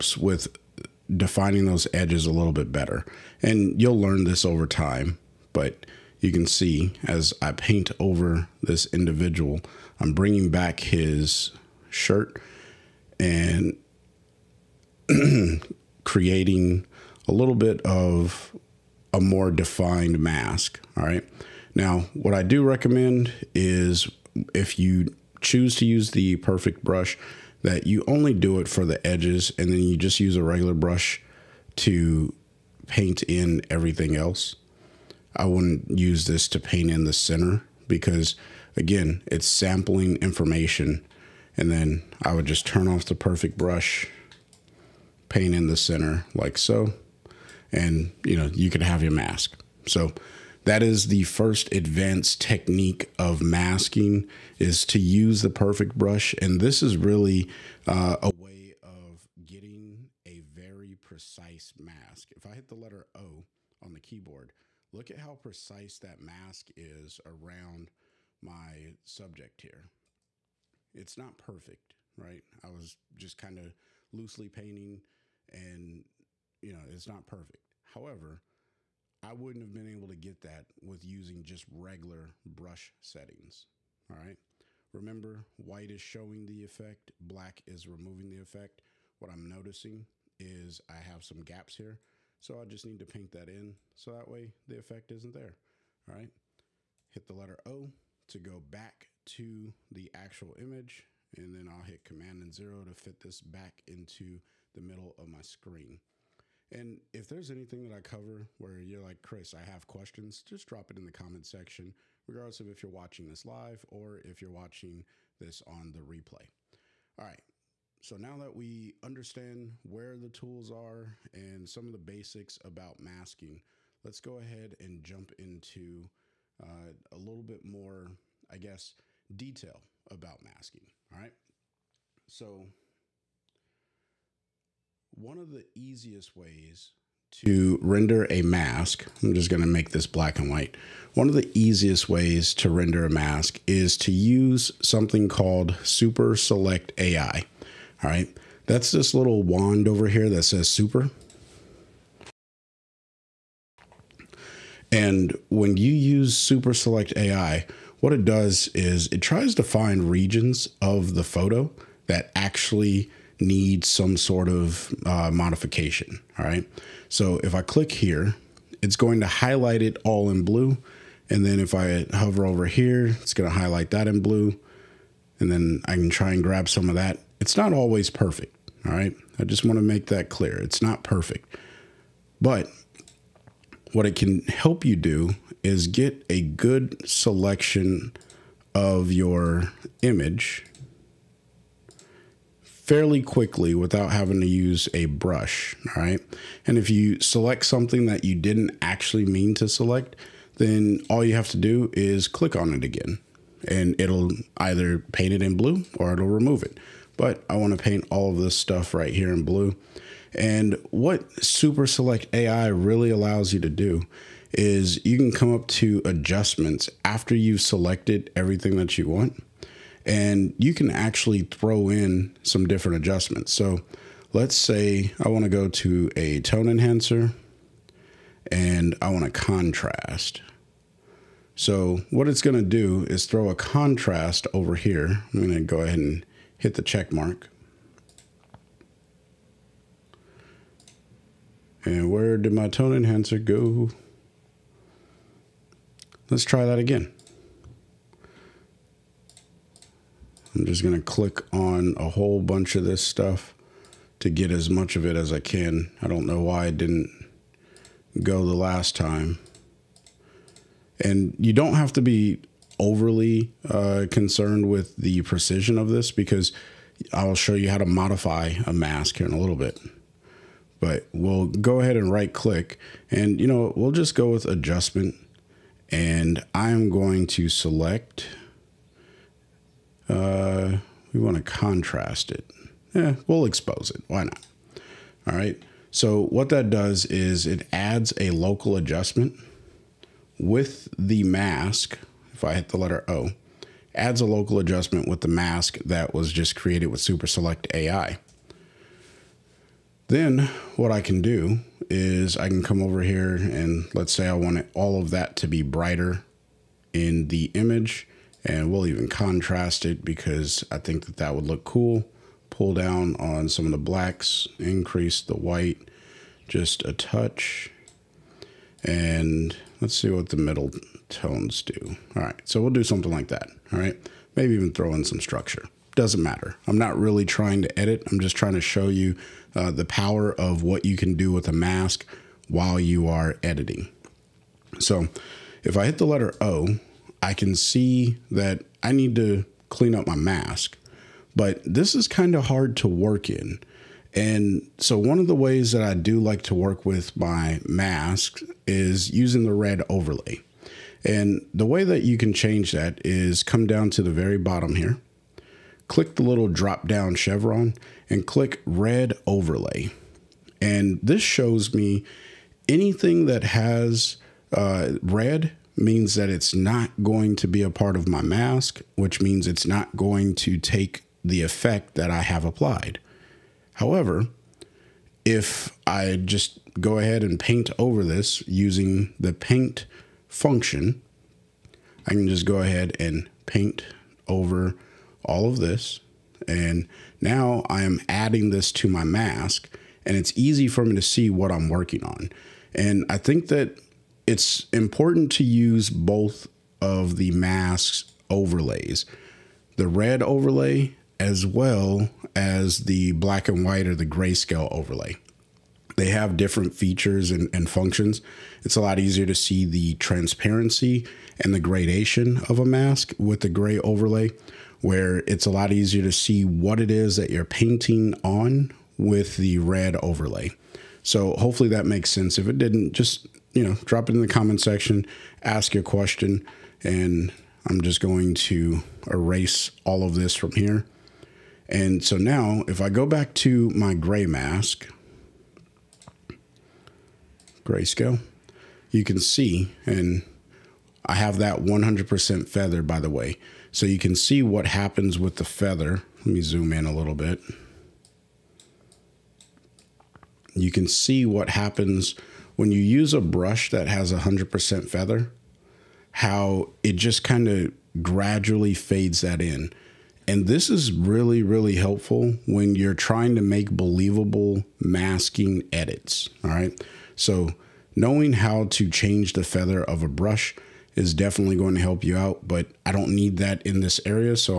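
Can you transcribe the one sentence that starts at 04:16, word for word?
I don't know why I didn't go the last time.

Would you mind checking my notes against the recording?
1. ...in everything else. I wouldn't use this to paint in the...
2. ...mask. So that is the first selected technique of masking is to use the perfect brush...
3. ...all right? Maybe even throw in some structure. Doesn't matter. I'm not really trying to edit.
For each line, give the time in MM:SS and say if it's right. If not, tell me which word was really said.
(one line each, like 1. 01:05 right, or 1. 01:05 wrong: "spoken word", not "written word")
1. 00:33 right
2. 00:49 wrong: "advanced", not "selected"
3. 05:23 right.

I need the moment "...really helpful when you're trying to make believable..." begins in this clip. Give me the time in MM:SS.
07:41.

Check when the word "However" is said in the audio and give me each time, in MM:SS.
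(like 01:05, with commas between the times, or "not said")
01:17, 06:13.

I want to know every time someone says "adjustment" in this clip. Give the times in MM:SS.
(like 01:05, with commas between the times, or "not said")
03:36, 03:42, 04:34, 04:48, 04:54.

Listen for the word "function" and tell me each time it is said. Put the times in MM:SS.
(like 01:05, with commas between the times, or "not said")
06:20, 06:47.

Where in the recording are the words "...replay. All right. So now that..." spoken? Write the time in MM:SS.
01:55.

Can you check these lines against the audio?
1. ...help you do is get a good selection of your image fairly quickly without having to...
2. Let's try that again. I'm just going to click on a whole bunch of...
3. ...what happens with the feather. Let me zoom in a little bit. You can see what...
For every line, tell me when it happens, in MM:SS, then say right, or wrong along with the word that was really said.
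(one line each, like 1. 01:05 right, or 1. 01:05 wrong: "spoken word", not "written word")
1. 03:04 right
2. 04:06 right
3. 07:24 right.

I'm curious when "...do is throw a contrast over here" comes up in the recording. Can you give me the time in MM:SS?
03:52.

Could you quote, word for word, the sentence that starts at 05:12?
Pull down on some of the blacks, increase the white just a touch.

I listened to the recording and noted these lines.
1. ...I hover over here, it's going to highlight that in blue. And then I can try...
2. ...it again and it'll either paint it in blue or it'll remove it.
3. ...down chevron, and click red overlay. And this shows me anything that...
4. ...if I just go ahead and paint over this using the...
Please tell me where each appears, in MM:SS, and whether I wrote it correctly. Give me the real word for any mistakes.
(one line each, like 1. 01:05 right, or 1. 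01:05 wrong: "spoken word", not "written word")
1. 02:51 right
2. 03:22 right
3. 05:56 right
4. 06:15 right.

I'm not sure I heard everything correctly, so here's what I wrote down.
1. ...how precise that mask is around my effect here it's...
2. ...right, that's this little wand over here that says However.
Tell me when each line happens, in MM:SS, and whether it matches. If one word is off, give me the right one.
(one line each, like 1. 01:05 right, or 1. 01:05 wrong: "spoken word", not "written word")
1. 01:05 wrong: "subject", not "effect"
2. 02:28 wrong: "Super", not "However".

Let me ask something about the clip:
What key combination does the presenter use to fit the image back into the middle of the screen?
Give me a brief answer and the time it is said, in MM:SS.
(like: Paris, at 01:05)
Command and zero, at 01:42.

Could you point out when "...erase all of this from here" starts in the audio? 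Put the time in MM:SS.
07:09.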